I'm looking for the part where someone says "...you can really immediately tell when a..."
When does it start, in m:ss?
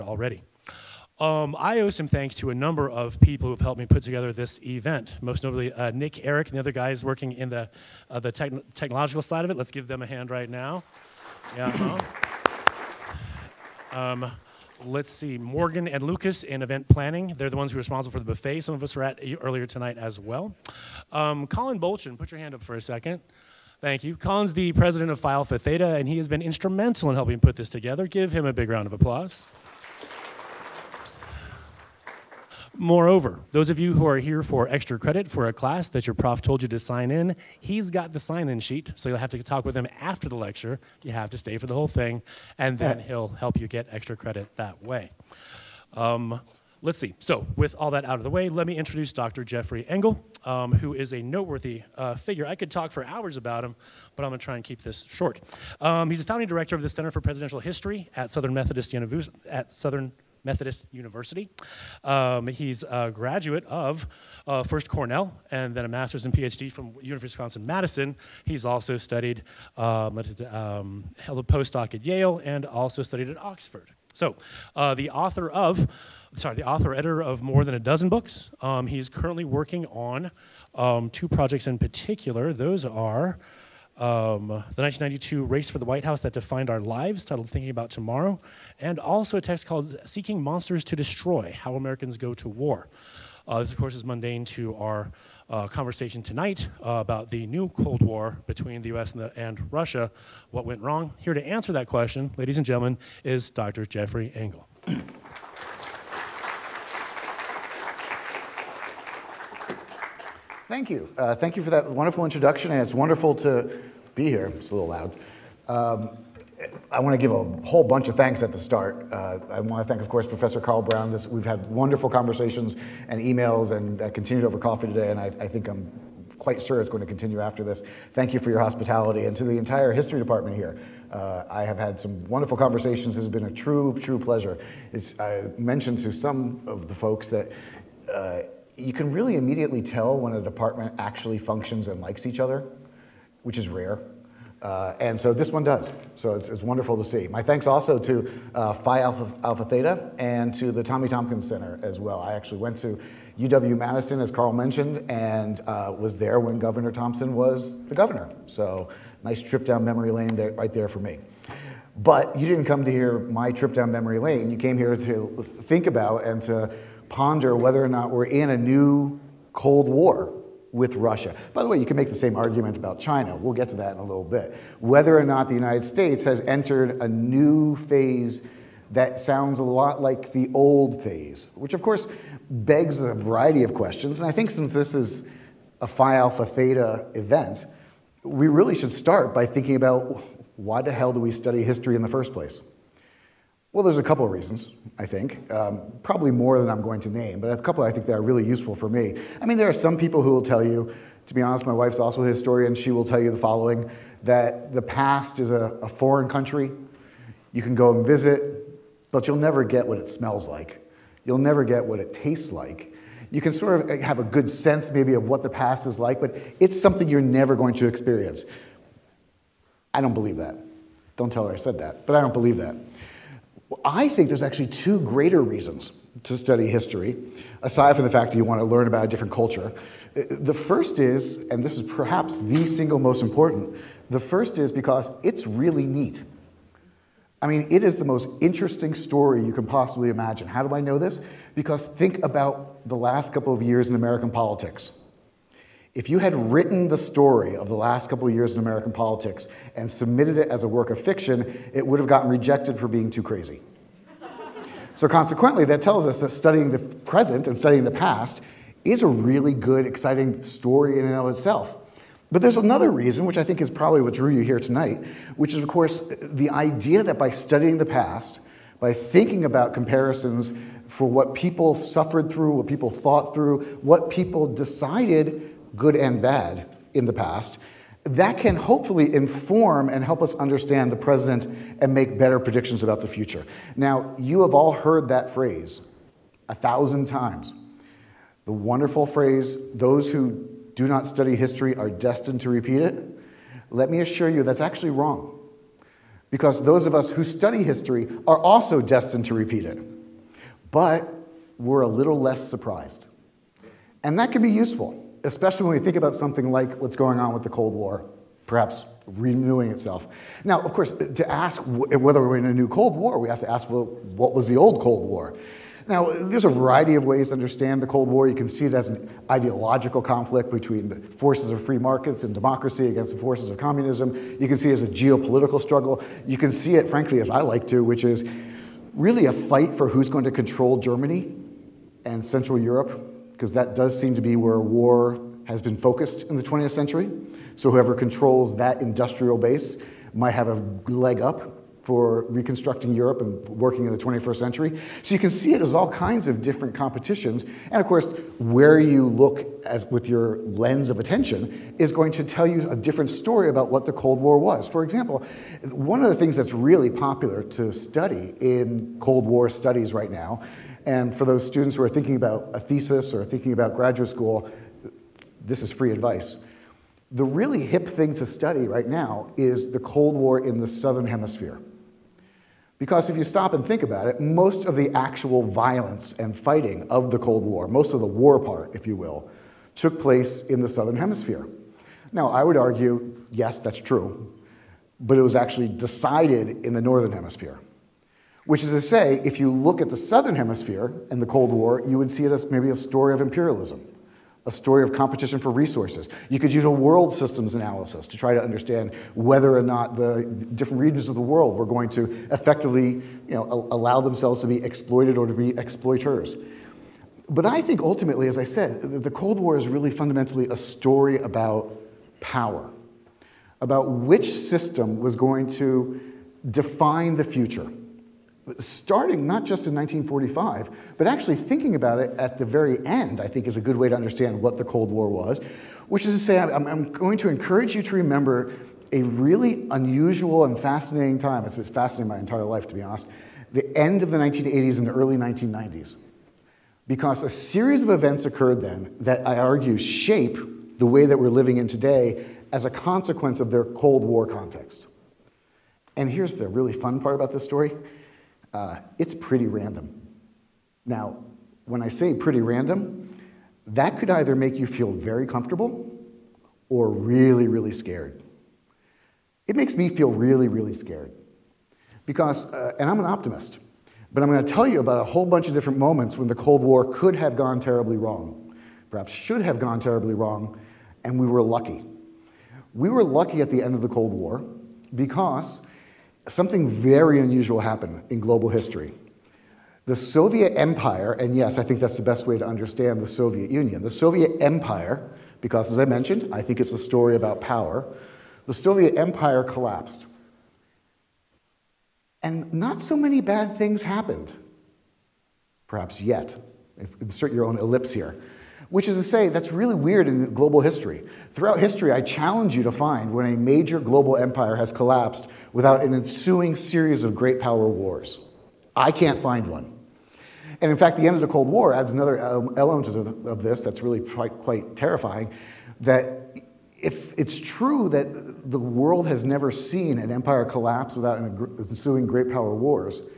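2:18.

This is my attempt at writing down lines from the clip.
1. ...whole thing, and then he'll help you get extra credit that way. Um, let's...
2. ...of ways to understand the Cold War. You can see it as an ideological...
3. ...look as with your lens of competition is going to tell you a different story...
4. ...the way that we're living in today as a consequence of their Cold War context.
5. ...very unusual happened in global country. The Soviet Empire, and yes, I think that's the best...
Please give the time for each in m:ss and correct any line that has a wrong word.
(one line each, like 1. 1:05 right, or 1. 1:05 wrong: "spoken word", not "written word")
1. 0:41 right
2. 5:16 right
3. 5:49 wrong: "attention", not "competition"
4. 7:20 right
5. 7:56 wrong: "history", not "country".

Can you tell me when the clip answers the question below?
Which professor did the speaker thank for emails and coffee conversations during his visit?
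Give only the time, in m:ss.
2:00.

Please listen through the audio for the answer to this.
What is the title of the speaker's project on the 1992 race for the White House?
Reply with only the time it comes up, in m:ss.
1:27.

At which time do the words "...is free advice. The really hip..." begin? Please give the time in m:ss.
6:05.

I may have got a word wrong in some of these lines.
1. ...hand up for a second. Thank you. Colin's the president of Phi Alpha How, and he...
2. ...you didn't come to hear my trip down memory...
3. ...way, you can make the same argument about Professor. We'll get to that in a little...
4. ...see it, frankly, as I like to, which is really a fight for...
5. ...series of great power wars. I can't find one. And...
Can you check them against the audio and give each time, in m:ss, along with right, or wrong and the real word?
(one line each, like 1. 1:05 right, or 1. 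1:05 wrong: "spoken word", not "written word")
1. 0:22 wrong: "Theta", not "How"
2. 2:42 right
3. 2:51 wrong: "China", not "Professor"
4. 5:26 right
5. 8:26 right.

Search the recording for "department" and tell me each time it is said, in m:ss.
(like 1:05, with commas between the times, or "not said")
2:10, 2:20.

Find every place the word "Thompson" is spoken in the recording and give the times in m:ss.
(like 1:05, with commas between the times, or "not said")
2:31, 2:36.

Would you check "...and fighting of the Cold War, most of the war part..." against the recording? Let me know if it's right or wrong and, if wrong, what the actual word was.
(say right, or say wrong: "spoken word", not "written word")
right.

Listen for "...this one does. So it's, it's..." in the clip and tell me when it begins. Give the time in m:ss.
2:25.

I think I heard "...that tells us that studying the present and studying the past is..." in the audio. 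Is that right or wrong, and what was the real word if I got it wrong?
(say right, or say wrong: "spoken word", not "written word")
right.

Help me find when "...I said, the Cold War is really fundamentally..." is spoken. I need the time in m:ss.
6:48.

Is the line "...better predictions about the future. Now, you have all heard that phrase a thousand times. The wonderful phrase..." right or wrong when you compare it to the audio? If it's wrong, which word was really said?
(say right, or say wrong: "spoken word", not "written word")
right.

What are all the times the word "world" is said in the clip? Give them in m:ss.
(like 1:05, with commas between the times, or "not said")
6:36, 6:41, 8:38.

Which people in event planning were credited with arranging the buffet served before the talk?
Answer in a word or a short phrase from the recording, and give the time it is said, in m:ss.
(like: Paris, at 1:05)
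Morgan and Lucas, at 0:15.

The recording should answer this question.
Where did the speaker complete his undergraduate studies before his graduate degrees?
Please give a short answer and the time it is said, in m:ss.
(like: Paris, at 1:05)
Cornell, at 1:04.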